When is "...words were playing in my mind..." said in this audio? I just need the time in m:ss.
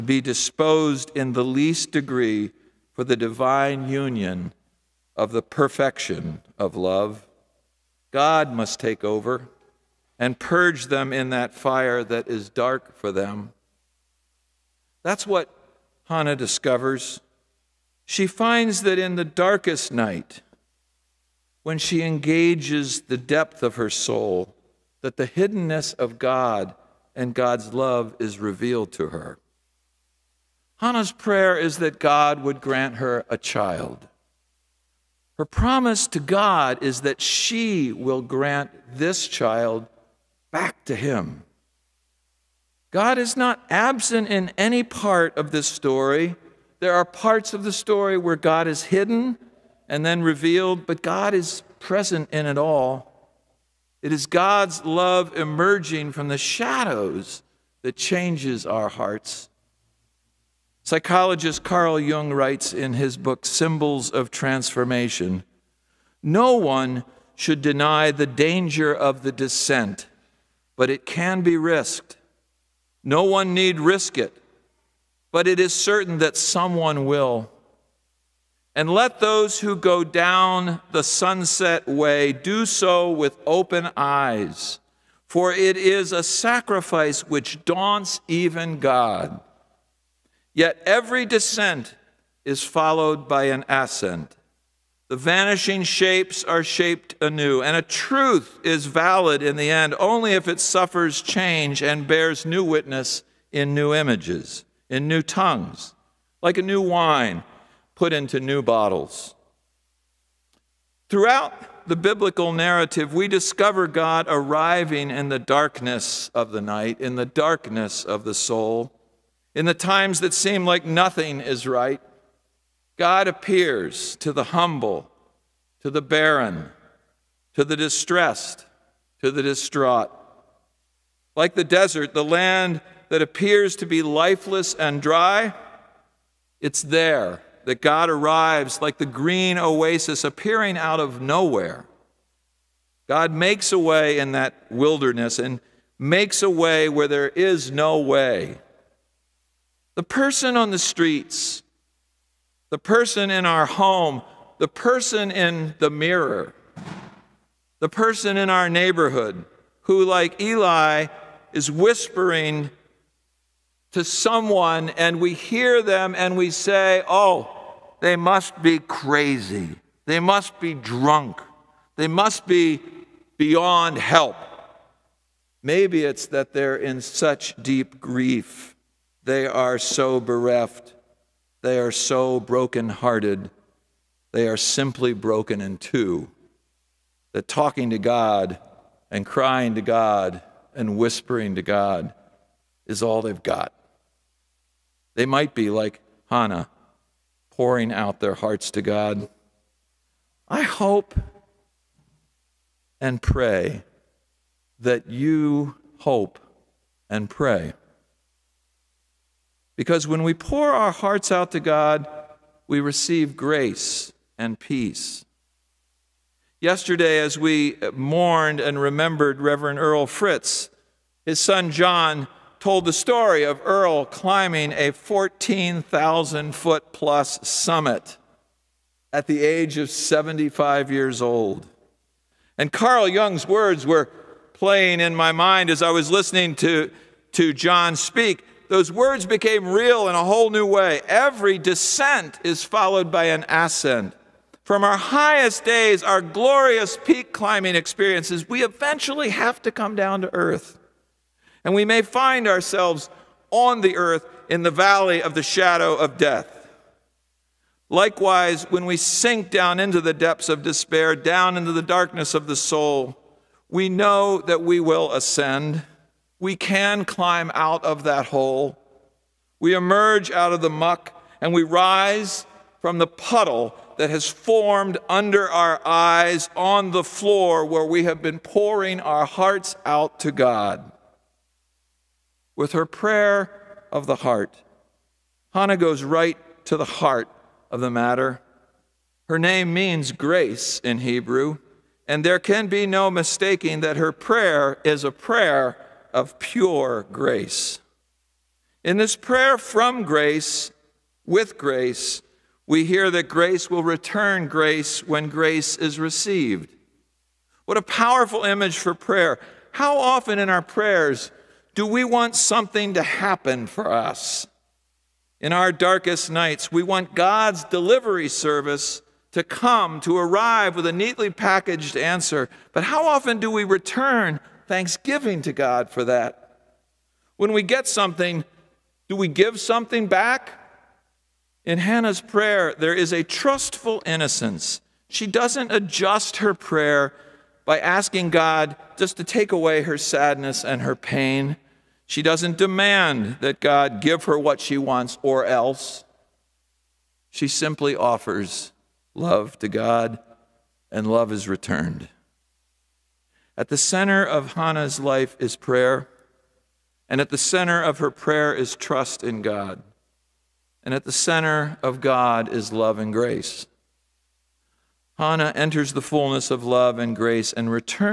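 3:53.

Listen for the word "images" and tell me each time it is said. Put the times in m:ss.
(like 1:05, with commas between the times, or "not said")
1:43, 5:08.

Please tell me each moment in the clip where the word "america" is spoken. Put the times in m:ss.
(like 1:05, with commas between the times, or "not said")
not said.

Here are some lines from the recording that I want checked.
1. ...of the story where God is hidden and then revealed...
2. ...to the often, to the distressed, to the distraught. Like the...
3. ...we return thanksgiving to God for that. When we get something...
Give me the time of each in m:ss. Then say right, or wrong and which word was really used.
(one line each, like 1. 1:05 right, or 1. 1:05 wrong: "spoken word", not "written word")
1. 0:47 right
2. 2:05 wrong: "barren", not "often"
3. 5:23 right.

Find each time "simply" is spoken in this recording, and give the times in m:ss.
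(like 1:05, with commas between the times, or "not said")
3:04, 5:47.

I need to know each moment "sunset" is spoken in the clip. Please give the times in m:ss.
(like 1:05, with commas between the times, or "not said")
1:21.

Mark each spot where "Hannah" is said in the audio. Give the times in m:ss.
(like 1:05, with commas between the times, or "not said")
0:16, 0:30, 3:16, 4:45, 5:31, 5:54, 6:05.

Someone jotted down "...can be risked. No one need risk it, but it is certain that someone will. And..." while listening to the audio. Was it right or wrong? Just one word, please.
right.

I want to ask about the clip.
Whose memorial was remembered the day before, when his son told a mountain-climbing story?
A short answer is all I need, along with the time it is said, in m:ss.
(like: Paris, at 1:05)
Reverend Earl Fritz, at 3:39.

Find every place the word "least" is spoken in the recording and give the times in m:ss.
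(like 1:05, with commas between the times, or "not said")
0:01.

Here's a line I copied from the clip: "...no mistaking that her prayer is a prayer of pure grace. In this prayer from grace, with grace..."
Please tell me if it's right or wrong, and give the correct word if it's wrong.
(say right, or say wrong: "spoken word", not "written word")
right.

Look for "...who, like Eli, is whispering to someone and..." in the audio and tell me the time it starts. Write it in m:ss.
2:39.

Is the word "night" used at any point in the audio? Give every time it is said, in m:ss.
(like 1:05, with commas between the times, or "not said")
0:19, 1:56, 5:16.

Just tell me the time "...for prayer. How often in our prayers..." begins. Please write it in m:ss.
5:08.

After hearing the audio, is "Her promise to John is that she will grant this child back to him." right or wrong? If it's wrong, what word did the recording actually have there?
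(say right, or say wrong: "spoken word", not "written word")
wrong: "God", not "John".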